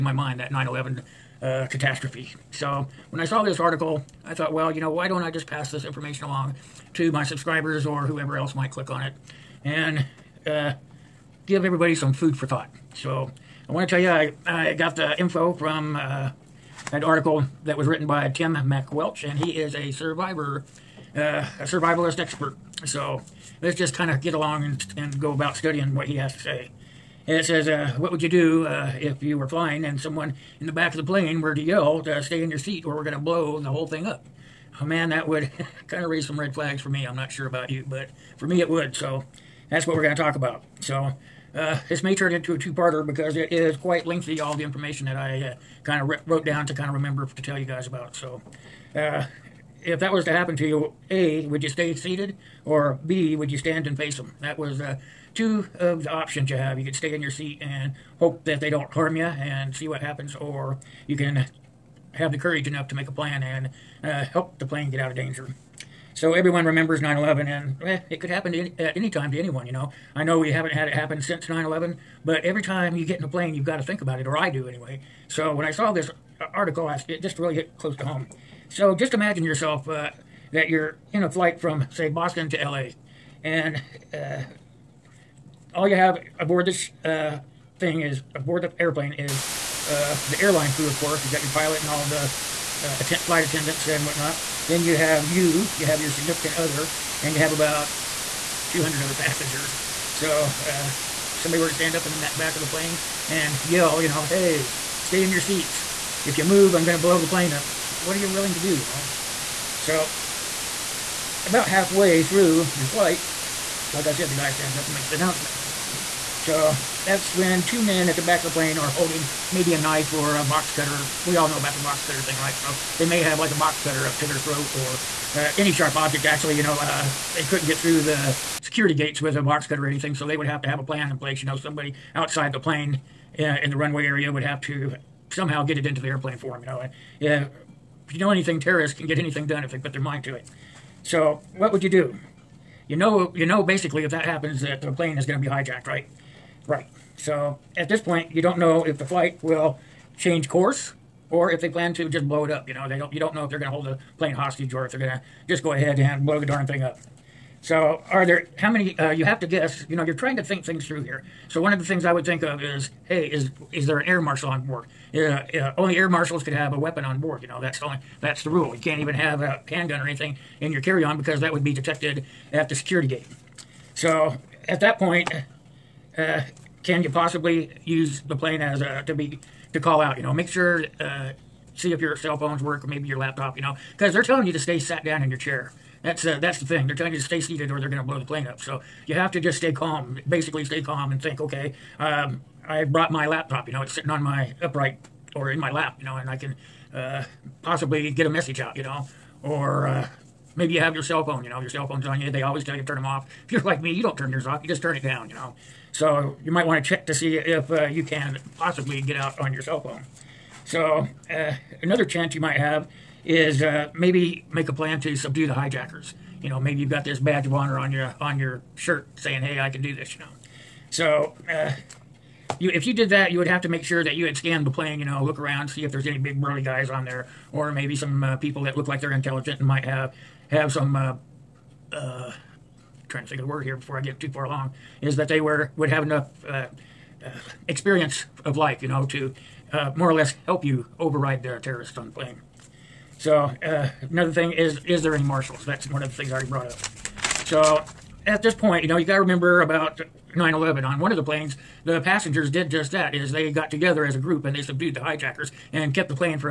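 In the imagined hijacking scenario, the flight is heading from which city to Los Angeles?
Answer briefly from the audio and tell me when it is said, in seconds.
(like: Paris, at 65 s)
Boston, at 82 s.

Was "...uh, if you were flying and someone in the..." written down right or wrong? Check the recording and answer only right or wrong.
right.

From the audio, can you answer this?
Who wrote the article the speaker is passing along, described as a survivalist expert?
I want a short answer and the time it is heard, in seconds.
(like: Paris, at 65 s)
Tim MacWelch, at 18 s.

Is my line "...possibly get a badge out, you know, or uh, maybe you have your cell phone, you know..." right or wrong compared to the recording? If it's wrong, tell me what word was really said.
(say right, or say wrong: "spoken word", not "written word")
wrong: "message", not "badge".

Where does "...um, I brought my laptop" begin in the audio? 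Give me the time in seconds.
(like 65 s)
191 s.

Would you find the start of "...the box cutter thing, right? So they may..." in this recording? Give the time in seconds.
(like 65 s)
121 s.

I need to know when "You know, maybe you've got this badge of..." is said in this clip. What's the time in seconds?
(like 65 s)
216 s.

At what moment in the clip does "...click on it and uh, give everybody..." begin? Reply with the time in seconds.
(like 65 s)
8 s.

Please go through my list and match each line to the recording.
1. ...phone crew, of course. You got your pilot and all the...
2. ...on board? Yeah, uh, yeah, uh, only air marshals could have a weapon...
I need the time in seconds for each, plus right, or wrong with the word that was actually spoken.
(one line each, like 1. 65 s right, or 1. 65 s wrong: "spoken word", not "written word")
1. 90 s wrong: "airline", not "phone"
2. 164 s right.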